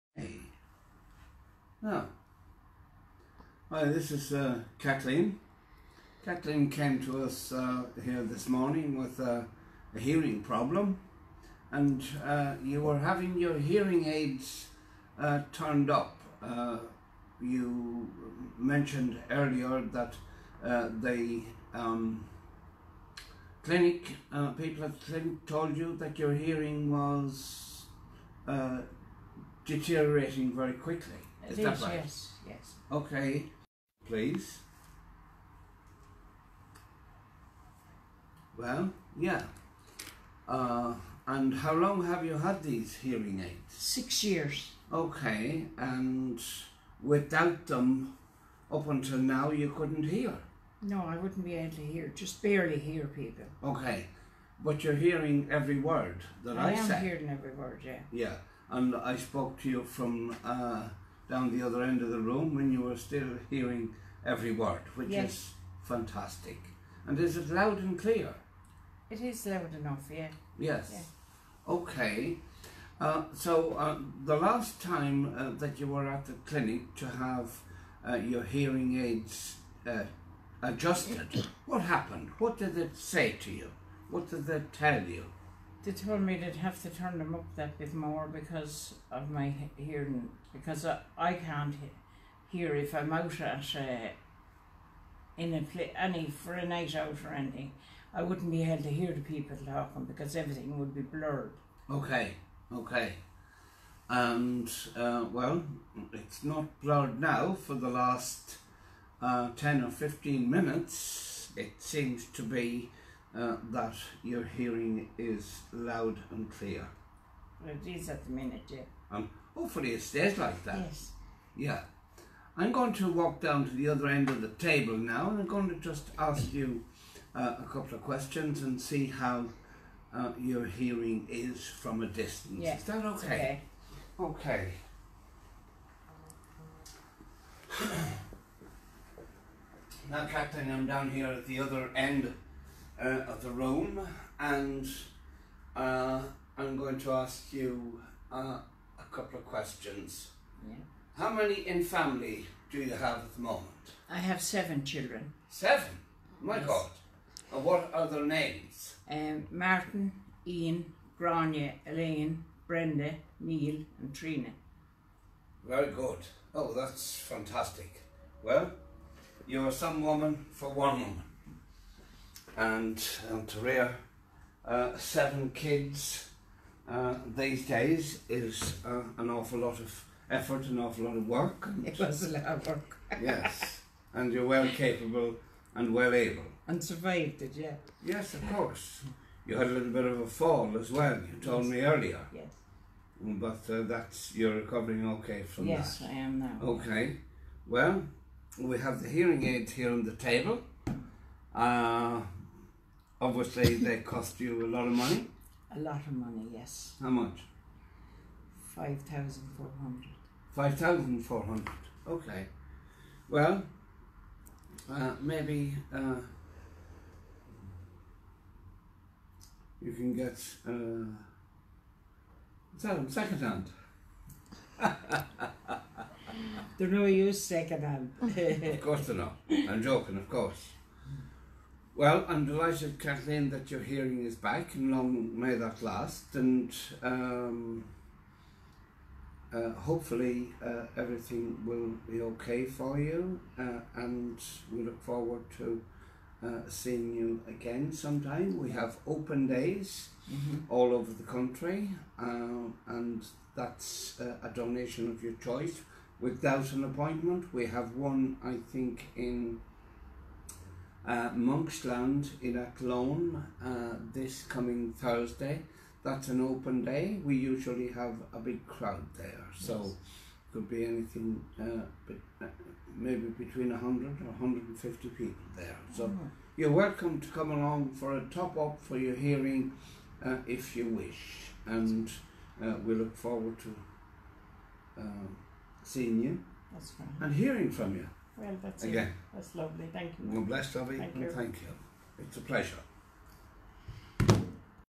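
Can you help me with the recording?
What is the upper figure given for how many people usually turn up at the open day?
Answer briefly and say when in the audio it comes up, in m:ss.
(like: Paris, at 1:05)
150, at 4:34.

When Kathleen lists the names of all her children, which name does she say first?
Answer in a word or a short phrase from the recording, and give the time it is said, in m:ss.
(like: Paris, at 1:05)
Martin, at 2:39.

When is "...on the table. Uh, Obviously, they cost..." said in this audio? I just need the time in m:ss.
3:19.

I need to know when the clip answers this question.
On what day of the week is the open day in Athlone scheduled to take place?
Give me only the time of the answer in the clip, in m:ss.
4:24.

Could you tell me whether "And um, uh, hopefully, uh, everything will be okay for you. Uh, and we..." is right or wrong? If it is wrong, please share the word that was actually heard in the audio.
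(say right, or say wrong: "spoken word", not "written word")
right.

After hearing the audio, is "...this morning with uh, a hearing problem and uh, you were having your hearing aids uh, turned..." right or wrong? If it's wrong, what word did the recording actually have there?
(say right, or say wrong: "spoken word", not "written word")
right.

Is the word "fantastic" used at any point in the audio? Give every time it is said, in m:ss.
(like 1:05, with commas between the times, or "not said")
1:05, 2:47.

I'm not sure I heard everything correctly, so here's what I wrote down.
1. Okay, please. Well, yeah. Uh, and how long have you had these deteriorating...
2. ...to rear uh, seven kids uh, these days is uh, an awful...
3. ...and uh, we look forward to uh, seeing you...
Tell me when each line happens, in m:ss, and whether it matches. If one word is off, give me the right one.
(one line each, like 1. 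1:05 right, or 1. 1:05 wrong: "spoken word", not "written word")
1. 0:32 wrong: "hearing", not "deteriorating"
2. 2:53 right
3. 4:41 right.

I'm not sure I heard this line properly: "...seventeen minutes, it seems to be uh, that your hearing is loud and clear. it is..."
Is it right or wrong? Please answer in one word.
wrong.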